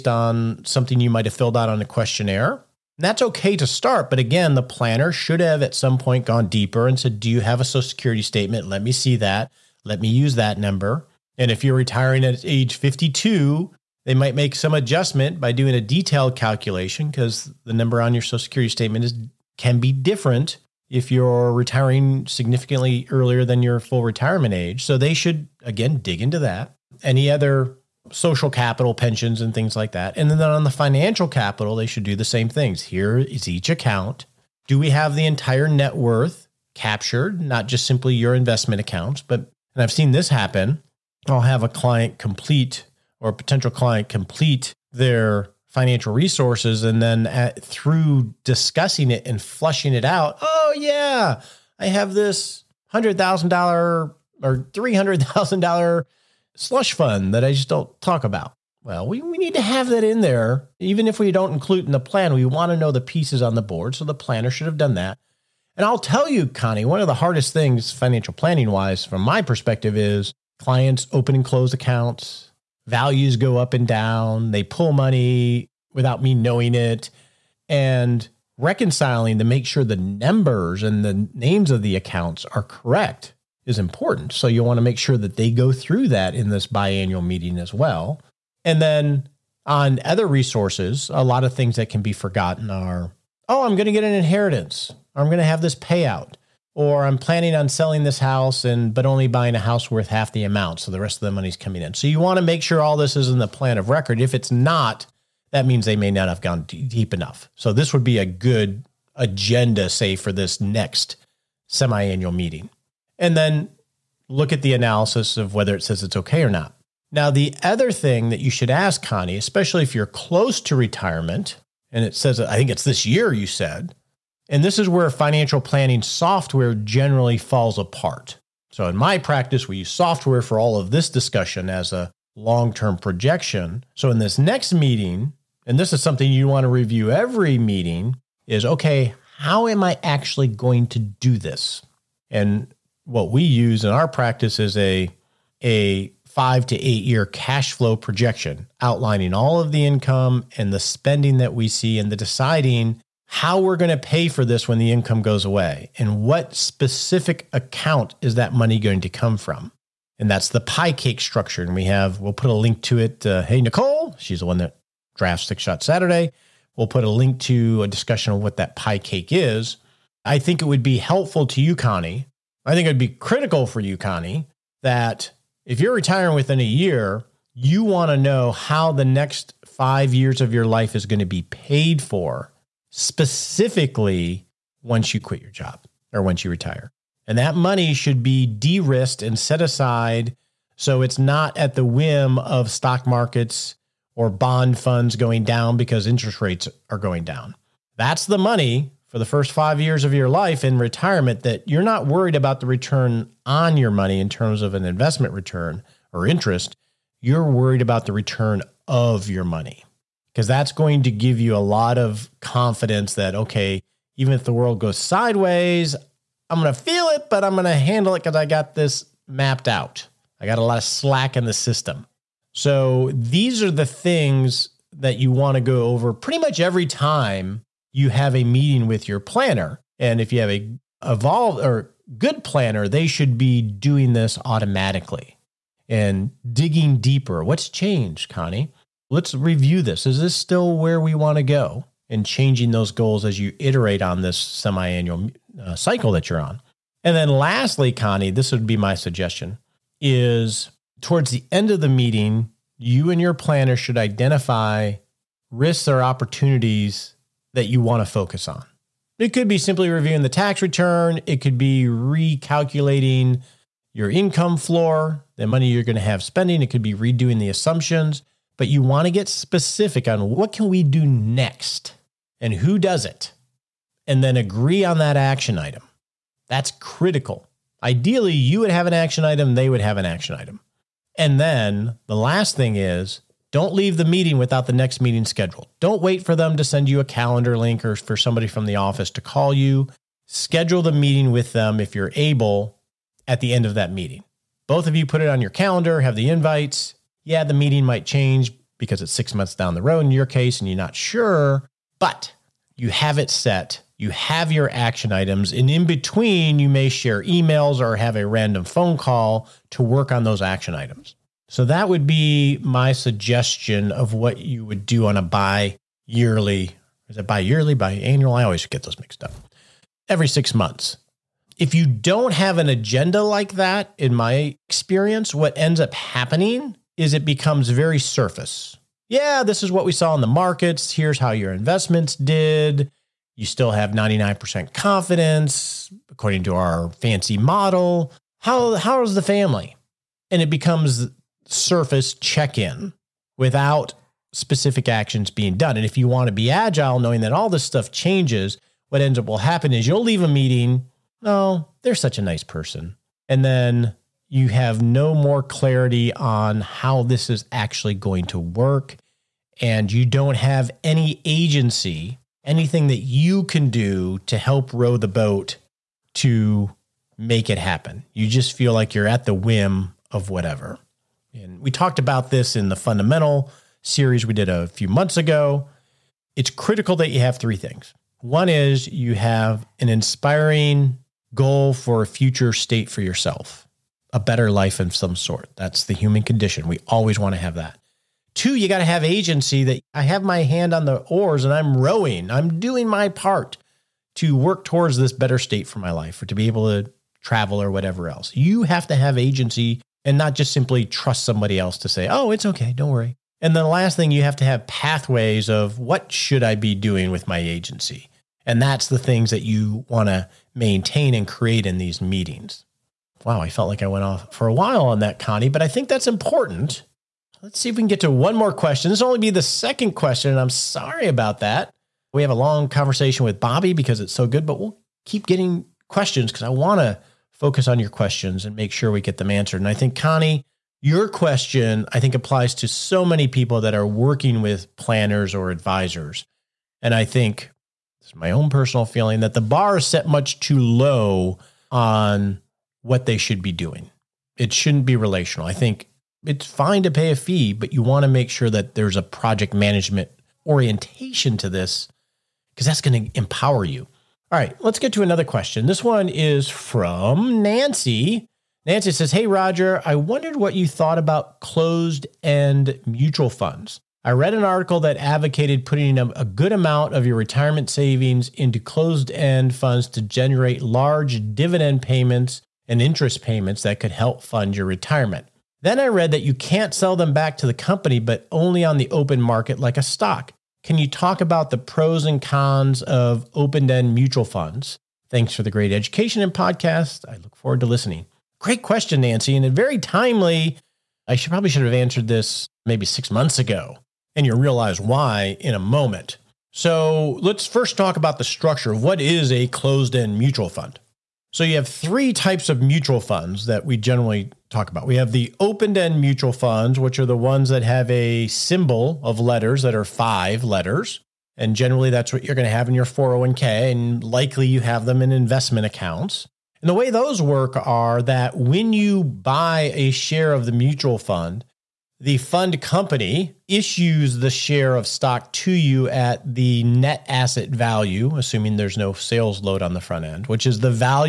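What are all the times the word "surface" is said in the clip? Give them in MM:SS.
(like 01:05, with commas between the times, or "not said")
05:27, 05:41.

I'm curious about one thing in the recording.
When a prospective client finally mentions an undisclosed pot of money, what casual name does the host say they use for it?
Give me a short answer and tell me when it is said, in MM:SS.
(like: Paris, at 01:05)
slush fund, at 00:56.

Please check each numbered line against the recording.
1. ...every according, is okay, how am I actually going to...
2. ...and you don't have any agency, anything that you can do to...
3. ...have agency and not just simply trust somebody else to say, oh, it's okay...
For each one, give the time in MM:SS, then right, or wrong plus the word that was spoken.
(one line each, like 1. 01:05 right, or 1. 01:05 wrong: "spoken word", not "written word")
1. 02:17 wrong: "meeting", not "according"
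2. 05:59 right
3. 06:38 right.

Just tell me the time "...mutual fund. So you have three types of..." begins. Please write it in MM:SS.
08:20.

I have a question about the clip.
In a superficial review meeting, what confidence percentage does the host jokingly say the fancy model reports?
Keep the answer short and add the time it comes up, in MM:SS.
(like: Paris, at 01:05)
99%, at 05:33.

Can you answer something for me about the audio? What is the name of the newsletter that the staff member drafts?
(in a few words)
Six Shot Saturday.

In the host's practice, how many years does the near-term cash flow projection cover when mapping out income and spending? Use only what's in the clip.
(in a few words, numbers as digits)
5 to 8 years.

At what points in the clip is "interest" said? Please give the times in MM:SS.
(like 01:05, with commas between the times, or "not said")
03:16, 03:26, 07:52.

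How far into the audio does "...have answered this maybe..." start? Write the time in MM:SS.
08:11.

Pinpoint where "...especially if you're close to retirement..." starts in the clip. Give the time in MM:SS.
01:59.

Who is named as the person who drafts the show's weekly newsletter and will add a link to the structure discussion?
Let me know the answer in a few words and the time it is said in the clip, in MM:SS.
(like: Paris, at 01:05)
Nicole, at 02:43.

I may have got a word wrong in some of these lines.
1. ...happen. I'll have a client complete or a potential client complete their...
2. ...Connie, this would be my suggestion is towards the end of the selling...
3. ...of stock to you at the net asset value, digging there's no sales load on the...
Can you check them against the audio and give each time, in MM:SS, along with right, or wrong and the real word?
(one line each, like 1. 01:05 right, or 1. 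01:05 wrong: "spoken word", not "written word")
1. 00:40 right
2. 04:07 wrong: "meeting", not "selling"
3. 08:44 wrong: "assuming", not "digging".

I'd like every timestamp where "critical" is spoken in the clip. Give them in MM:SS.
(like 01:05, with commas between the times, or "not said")
02:53, 04:36, 06:16.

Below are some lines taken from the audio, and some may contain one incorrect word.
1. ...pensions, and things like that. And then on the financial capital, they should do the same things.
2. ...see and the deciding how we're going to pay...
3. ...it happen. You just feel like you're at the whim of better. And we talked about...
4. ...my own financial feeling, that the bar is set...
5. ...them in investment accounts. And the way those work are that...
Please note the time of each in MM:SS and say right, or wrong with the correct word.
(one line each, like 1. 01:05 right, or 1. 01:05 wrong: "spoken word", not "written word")
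1. 00:28 right
2. 02:31 right
3. 06:07 wrong: "whatever", not "better"
4. 07:18 wrong: "personal", not "financial"
5. 08:34 right.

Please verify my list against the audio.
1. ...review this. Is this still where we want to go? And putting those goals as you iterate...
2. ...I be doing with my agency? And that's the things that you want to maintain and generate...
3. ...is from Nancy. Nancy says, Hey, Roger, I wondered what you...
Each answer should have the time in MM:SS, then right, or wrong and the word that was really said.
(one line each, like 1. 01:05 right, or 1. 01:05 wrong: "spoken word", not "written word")
1. 03:59 wrong: "changing", not "putting"
2. 06:46 wrong: "create", not "generate"
3. 07:36 right.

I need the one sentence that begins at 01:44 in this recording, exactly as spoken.
If it's not, that means they may not have gone deep enough.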